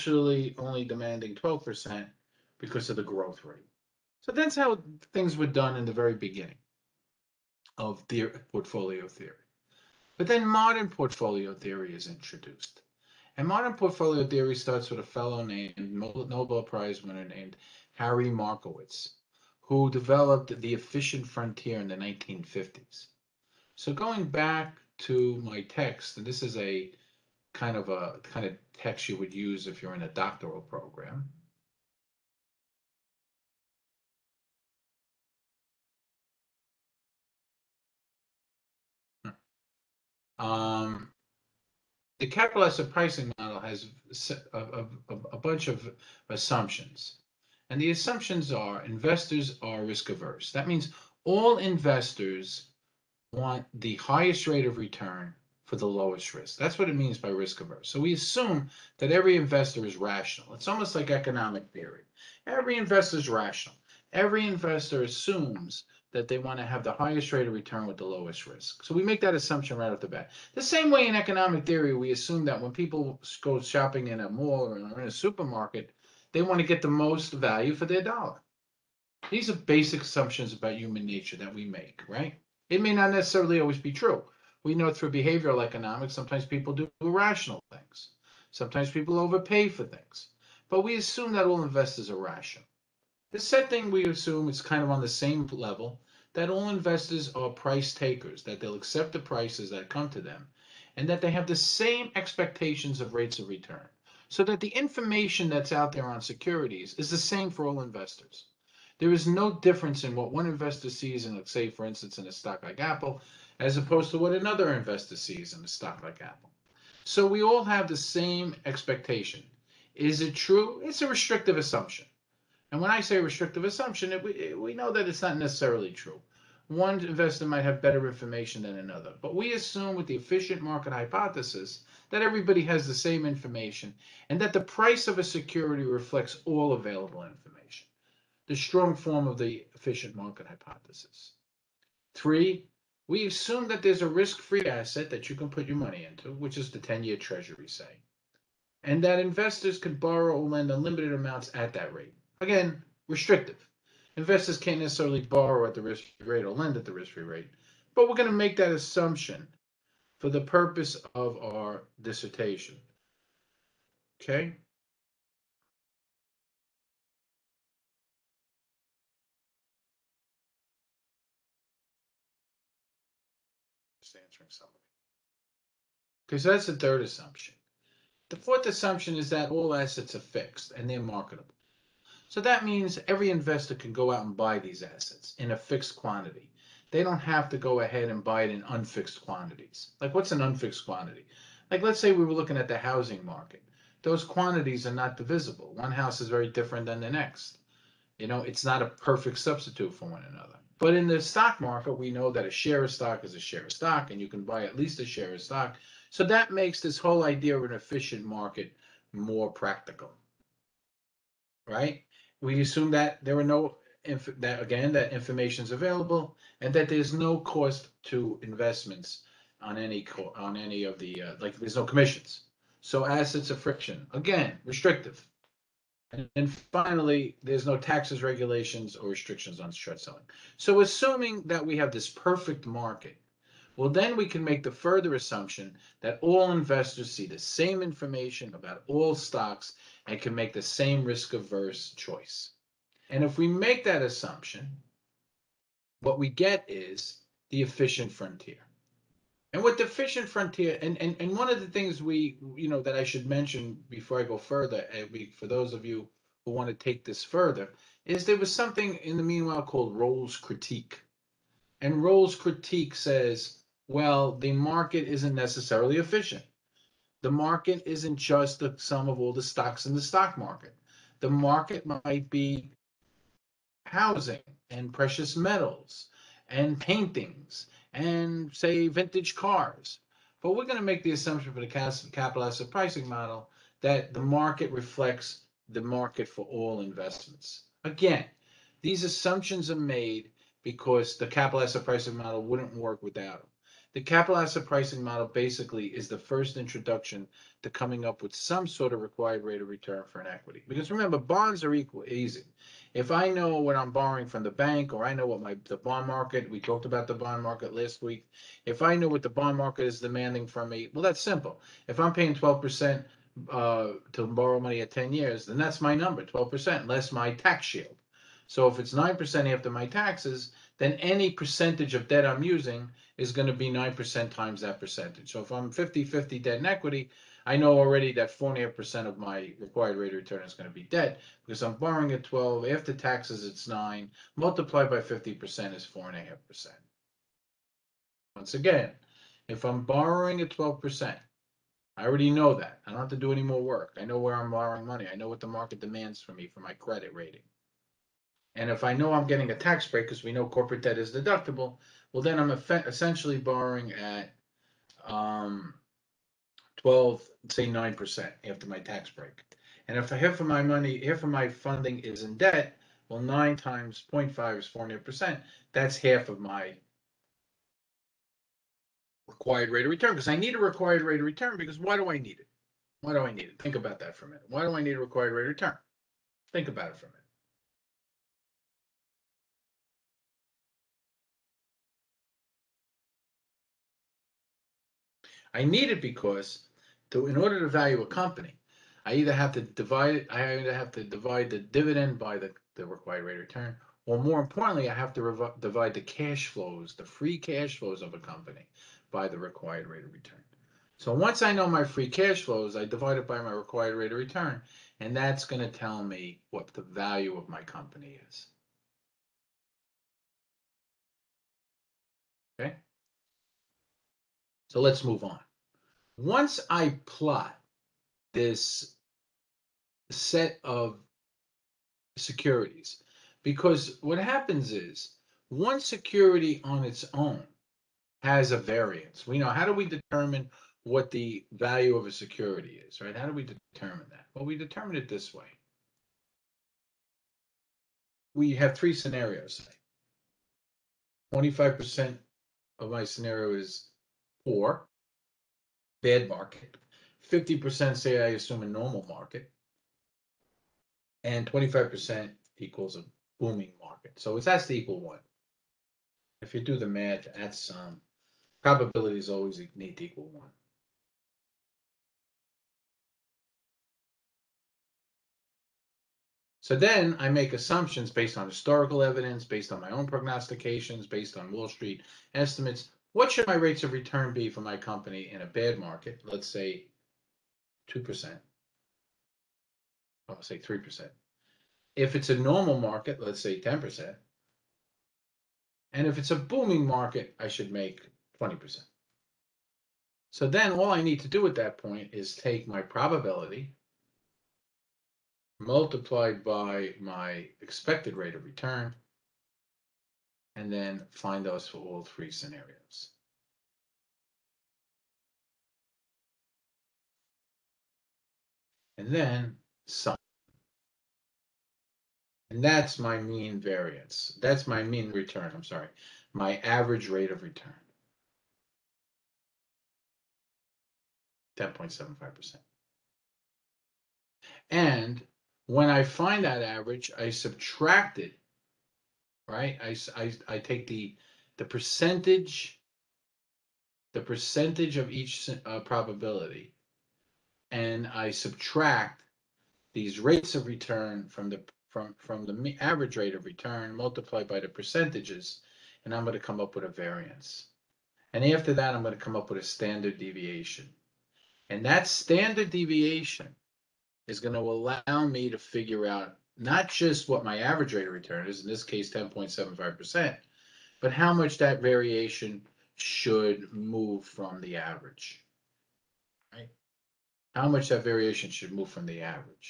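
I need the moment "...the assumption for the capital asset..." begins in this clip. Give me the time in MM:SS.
04:41.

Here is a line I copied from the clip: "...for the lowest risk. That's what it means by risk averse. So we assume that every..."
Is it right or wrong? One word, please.
right.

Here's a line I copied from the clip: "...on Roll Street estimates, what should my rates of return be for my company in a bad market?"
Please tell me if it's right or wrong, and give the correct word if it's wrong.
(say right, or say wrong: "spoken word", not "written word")
wrong: "Wall", not "Roll".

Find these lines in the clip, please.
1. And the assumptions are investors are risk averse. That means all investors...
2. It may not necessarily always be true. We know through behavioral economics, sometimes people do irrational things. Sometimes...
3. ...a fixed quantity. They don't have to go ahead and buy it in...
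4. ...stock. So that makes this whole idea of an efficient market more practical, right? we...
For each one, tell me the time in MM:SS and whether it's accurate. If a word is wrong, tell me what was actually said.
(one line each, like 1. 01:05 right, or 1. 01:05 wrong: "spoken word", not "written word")
1. 00:47 right
2. 01:22 right
3. 03:05 right
4. 03:25 right.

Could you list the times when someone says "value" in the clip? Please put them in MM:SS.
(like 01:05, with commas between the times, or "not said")
01:17, 06:27, 06:46, 07:11.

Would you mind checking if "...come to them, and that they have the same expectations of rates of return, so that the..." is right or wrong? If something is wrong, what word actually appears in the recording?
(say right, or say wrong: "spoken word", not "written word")
right.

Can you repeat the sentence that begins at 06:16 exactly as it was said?
Think about it for a minute.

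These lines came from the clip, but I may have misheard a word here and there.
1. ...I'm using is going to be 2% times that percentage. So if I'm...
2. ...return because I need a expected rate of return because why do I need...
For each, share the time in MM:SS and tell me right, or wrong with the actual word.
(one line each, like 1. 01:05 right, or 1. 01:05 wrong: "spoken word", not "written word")
1. 05:22 wrong: "9", not "2"
2. 06:09 wrong: "required", not "expected".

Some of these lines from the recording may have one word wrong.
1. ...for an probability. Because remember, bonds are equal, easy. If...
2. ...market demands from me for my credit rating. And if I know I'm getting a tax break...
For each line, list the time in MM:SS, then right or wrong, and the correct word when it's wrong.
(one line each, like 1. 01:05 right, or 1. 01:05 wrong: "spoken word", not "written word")
1. 05:00 wrong: "equity", not "probability"
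2. 05:45 right.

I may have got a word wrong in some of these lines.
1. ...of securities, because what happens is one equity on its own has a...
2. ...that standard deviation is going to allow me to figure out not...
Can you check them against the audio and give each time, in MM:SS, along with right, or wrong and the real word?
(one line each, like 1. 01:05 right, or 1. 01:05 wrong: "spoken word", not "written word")
1. 07:00 wrong: "security", not "equity"
2. 09:11 right.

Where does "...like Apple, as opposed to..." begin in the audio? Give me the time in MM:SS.
01:52.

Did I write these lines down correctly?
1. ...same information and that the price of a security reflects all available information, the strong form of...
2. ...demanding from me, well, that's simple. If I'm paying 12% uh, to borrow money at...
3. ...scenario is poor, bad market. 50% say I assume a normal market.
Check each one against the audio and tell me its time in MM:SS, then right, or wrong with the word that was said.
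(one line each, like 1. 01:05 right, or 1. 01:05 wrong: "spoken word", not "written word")
1. 02:12 right
2. 05:09 right
3. 07:23 right.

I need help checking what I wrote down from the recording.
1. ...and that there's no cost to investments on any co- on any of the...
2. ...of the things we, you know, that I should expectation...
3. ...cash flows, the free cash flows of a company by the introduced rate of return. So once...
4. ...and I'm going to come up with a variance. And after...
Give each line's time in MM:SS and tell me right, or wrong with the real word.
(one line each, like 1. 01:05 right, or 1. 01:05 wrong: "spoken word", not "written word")
1. 03:36 right
2. 04:11 wrong: "mention", not "expectation"
3. 06:36 wrong: "required", not "introduced"
4. 09:06 right.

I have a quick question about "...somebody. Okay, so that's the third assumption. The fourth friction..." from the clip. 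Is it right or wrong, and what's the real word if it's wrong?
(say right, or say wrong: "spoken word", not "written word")
wrong: "assumption", not "friction".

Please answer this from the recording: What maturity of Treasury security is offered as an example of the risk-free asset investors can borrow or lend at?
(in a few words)
10 year.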